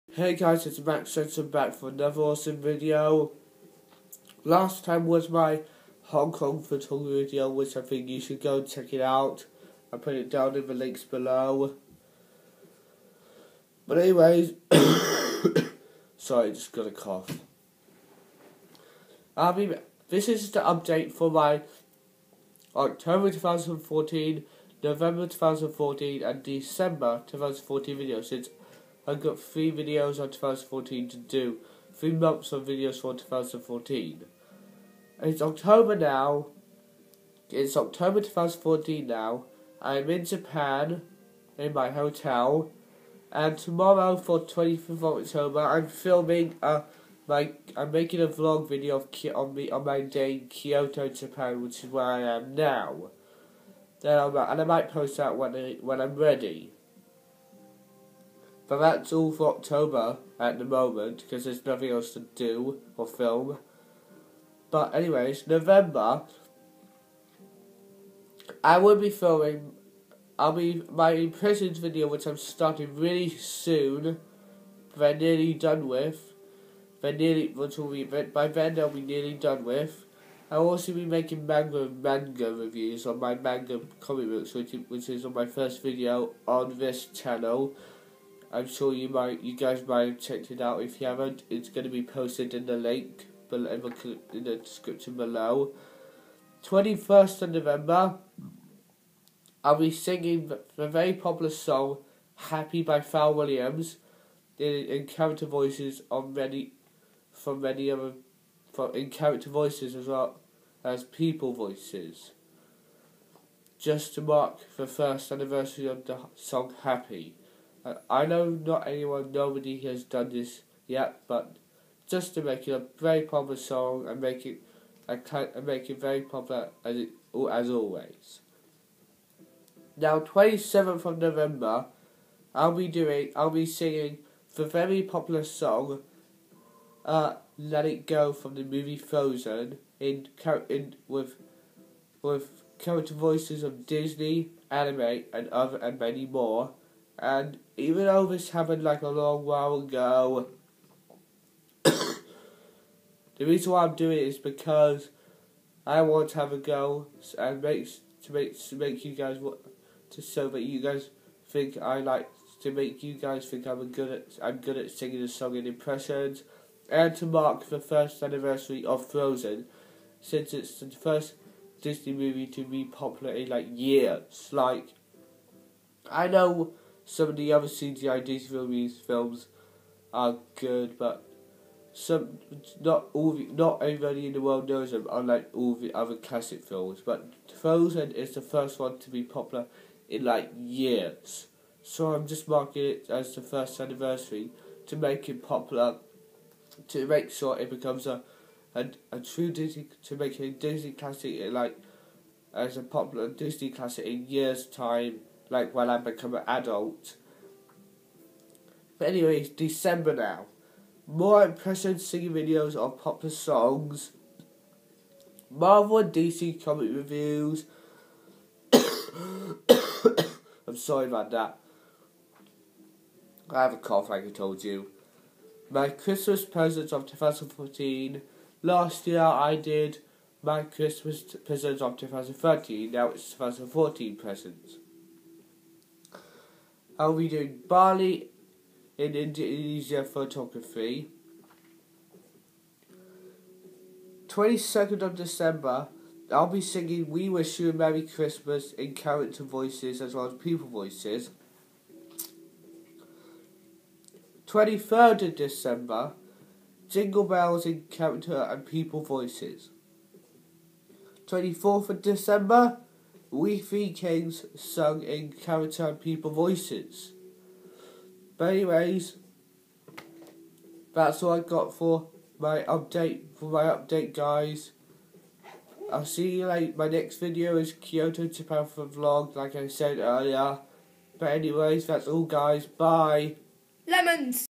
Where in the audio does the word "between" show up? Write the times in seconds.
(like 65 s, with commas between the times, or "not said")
not said.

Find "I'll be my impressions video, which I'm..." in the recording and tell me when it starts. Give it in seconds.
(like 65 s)
70 s.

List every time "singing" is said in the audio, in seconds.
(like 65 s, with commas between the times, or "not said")
99 s, 133 s, 164 s, 211 s, 246 s.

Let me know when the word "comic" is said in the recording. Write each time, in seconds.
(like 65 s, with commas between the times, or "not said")
83 s, 216 s.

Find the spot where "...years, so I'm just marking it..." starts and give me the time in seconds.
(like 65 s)
190 s.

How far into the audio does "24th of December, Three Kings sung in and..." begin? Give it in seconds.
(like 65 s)
261 s.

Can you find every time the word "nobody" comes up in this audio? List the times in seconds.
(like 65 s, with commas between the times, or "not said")
119 s.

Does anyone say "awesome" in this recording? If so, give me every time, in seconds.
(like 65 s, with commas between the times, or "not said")
2 s.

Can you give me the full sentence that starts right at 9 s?
I put it down in the links below.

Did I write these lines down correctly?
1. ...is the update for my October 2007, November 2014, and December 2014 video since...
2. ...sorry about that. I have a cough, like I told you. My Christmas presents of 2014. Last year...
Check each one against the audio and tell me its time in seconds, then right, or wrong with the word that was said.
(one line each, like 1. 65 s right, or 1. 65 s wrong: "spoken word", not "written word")
1. 20 s wrong: "2014", not "2007"
2. 220 s right.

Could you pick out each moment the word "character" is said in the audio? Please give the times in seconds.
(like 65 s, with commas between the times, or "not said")
105 s, 109 s, 142 s, 248 s, 257 s.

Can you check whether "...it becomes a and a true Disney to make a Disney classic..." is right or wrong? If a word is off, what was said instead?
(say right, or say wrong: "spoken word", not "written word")
right.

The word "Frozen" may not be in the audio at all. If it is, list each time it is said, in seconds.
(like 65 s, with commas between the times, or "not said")
138 s, 169 s, 187 s.